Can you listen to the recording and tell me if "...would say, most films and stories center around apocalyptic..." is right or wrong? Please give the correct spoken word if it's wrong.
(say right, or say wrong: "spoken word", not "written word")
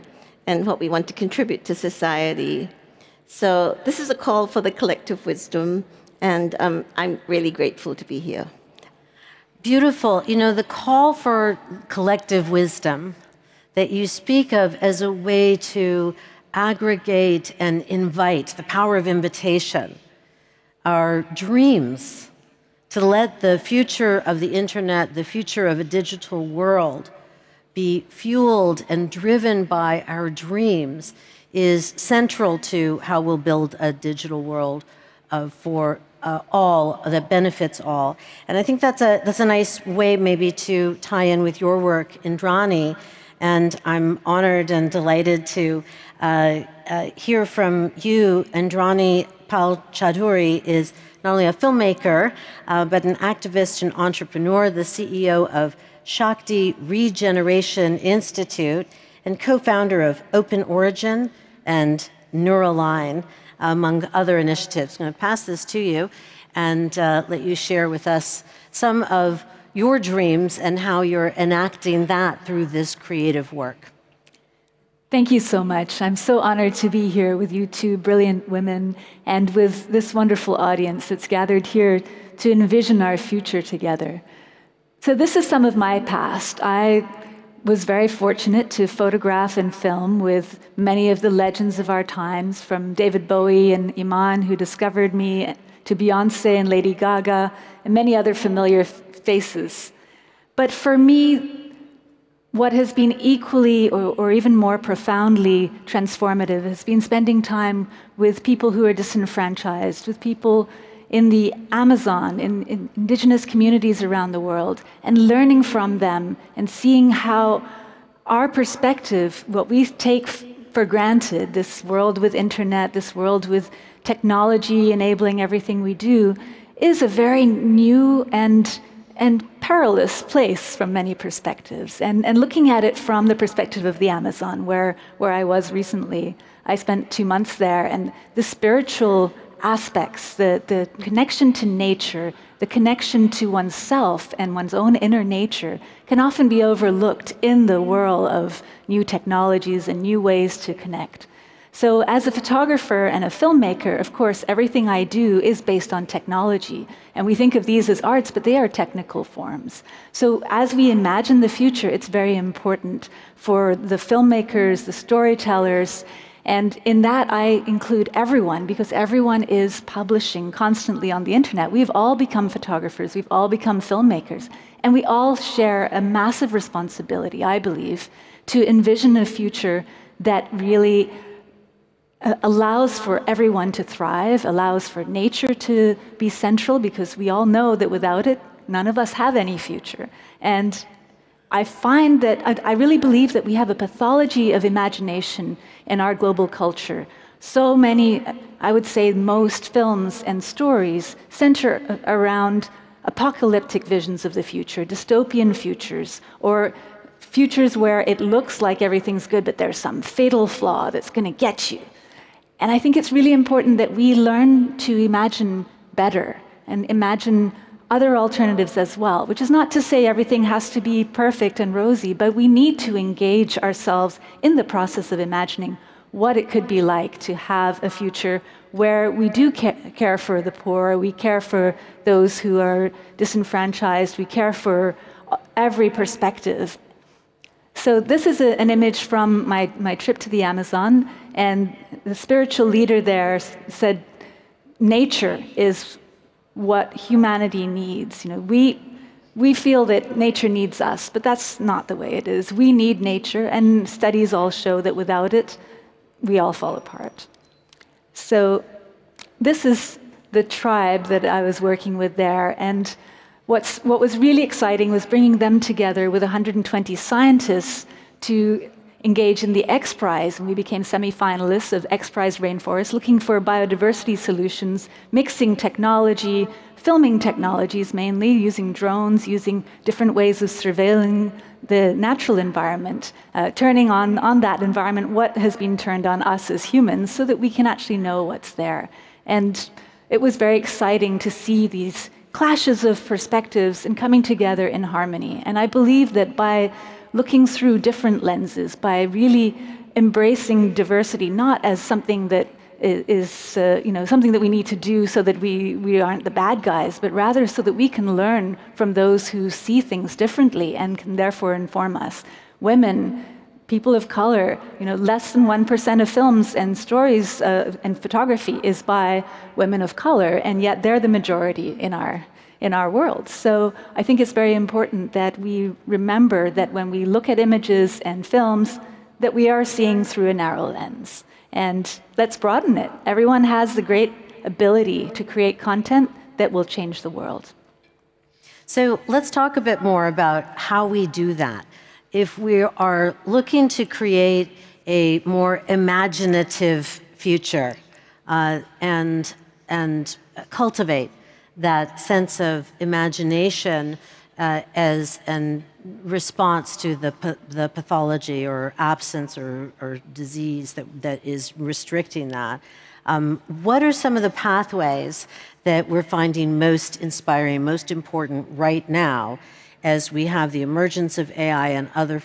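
right.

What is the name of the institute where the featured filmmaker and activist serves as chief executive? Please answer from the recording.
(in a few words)
Shakti Regeneration Institute.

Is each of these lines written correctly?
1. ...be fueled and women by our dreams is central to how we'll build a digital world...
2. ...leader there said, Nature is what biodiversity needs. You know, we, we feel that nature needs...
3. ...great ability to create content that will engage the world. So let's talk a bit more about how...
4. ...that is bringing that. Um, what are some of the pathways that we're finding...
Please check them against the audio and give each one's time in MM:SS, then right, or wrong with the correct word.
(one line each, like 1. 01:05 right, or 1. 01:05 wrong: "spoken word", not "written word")
1. 00:27 wrong: "driven", not "women"
2. 04:02 wrong: "humanity", not "biodiversity"
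3. 05:33 wrong: "change", not "engage"
4. 06:01 wrong: "restricting", not "bringing".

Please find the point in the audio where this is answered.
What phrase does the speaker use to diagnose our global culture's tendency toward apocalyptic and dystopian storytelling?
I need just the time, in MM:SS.
03:13.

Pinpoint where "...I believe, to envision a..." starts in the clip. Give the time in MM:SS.
02:57.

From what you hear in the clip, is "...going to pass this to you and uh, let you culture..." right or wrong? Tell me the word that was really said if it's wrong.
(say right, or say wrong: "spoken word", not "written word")
wrong: "share", not "culture".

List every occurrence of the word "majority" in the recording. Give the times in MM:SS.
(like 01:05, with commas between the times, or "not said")
05:21.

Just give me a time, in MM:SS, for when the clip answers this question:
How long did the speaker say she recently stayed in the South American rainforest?
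02:17.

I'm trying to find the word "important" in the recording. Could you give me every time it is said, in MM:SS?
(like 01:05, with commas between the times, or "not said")
02:42, 03:33, 05:24, 06:07.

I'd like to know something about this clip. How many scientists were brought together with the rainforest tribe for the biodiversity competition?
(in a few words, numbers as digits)
120.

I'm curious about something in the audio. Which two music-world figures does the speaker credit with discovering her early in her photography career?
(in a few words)
David Bowie and Iman.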